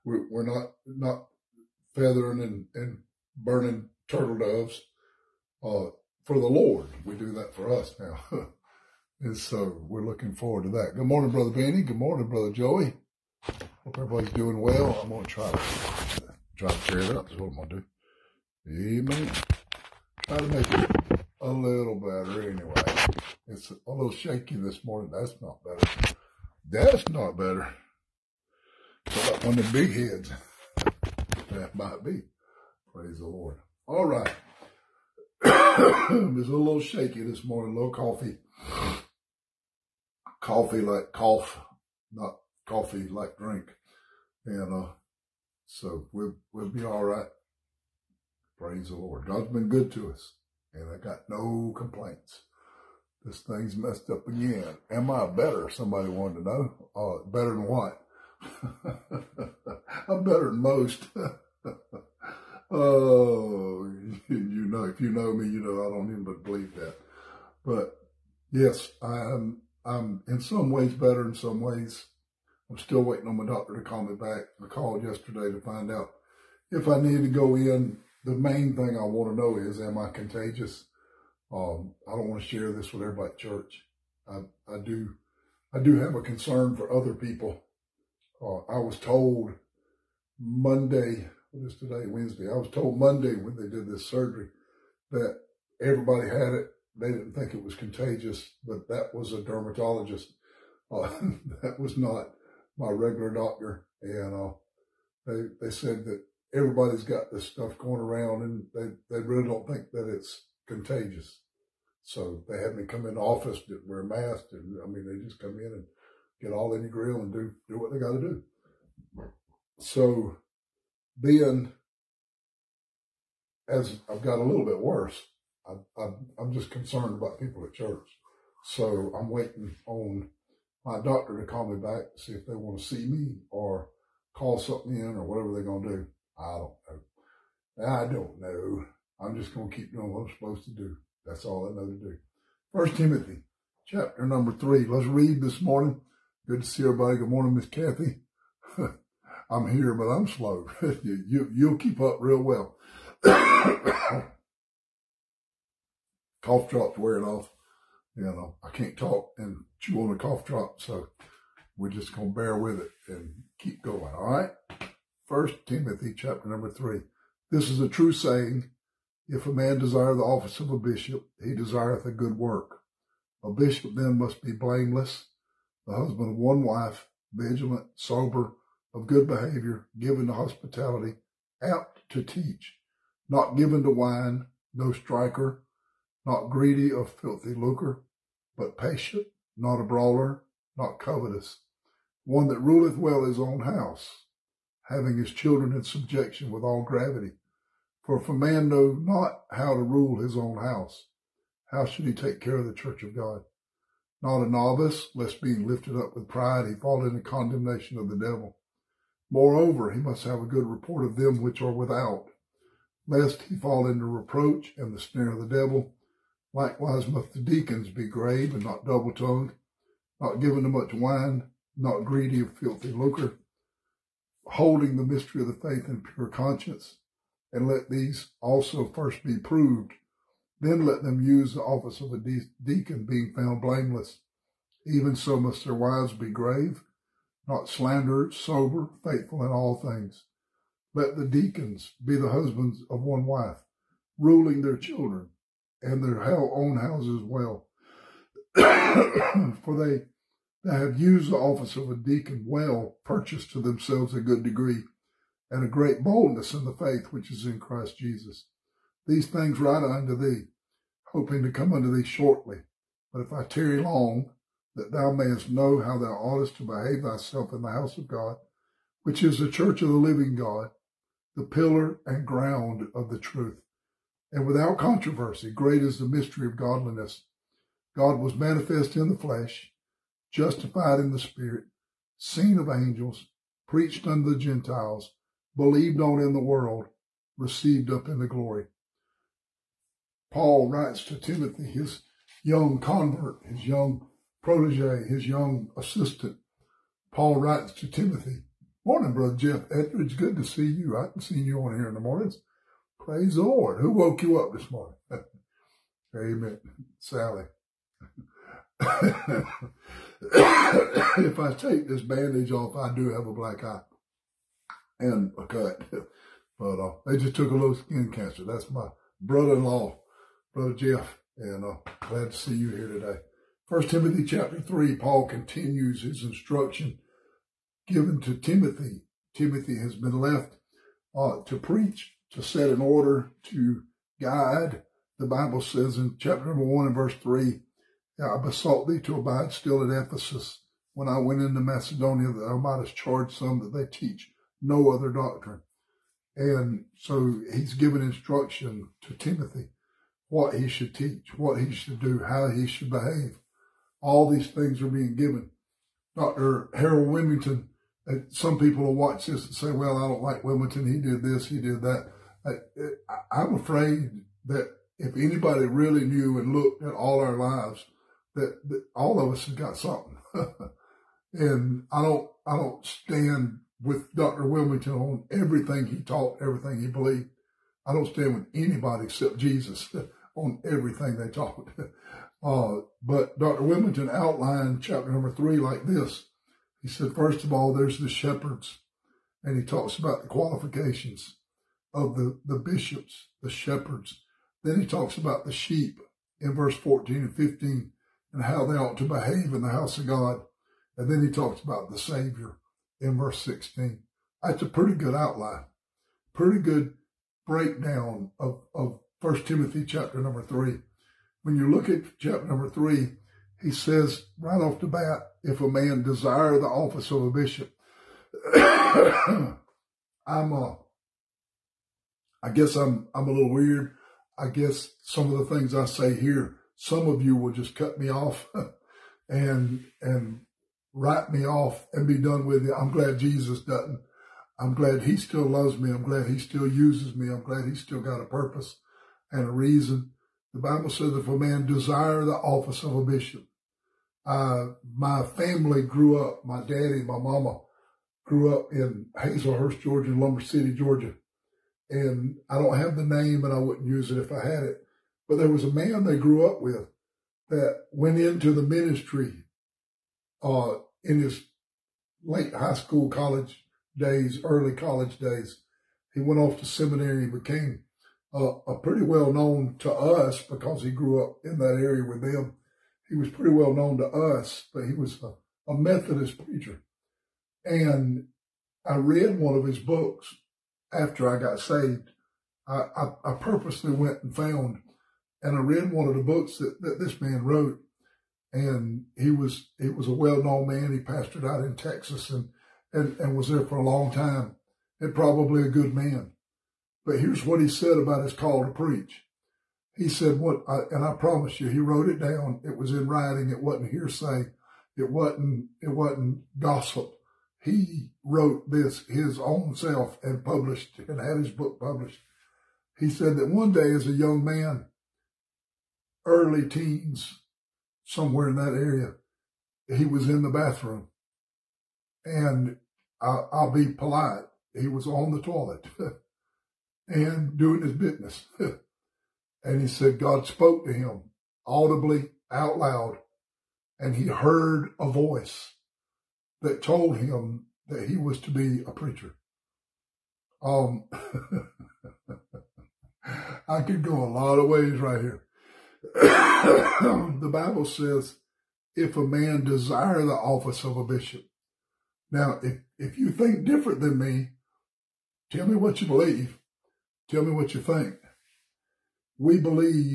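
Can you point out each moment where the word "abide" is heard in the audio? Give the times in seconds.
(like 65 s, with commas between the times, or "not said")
339 s.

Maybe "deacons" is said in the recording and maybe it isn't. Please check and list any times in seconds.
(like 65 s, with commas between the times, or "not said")
217 s, 232 s, 241 s, 251 s.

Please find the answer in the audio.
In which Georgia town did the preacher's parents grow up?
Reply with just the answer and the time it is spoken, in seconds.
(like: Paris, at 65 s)
Hazlehurst, at 449 s.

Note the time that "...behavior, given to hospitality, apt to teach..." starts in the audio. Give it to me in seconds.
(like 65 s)
179 s.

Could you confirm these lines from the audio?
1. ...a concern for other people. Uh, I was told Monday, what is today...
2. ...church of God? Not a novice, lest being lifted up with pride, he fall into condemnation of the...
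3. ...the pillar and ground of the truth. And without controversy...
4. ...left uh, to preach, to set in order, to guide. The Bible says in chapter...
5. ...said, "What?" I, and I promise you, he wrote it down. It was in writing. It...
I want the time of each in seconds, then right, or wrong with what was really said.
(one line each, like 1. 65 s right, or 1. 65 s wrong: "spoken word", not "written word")
1. 86 s right
2. 202 s right
3. 271 s right
4. 330 s right
5. 500 s right.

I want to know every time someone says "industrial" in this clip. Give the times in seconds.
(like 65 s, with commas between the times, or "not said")
not said.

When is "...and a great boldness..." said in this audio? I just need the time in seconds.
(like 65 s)
255 s.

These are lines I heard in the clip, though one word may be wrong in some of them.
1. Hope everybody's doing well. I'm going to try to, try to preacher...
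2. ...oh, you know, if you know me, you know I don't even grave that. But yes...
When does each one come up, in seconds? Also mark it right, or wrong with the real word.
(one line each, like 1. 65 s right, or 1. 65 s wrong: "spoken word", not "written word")
1. 13 s wrong: "cheer", not "preacher"
2. 62 s wrong: "believe", not "grave".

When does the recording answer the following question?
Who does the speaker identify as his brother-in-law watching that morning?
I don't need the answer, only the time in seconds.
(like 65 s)
299 s.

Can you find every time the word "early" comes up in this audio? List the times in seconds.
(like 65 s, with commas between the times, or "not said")
464 s, 516 s.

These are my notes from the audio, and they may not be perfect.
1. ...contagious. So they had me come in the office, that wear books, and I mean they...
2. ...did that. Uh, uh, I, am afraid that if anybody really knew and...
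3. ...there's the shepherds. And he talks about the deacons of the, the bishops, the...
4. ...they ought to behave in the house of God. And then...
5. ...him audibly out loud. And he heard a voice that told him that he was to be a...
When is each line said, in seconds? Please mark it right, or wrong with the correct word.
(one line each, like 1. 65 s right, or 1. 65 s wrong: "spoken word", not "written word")
1. 110 s wrong: "masks", not "books"
2. 361 s right
3. 387 s wrong: "qualifications", not "deacons"
4. 398 s right
5. 530 s right.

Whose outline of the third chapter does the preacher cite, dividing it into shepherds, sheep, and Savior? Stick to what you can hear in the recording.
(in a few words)
Dr. Harold Willmington.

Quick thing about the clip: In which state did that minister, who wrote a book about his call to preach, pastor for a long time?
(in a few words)
Texas.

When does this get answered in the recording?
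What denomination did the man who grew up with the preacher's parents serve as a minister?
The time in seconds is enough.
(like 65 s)
475 s.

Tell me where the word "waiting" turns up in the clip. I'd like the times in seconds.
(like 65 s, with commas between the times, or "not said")
73 s, 129 s.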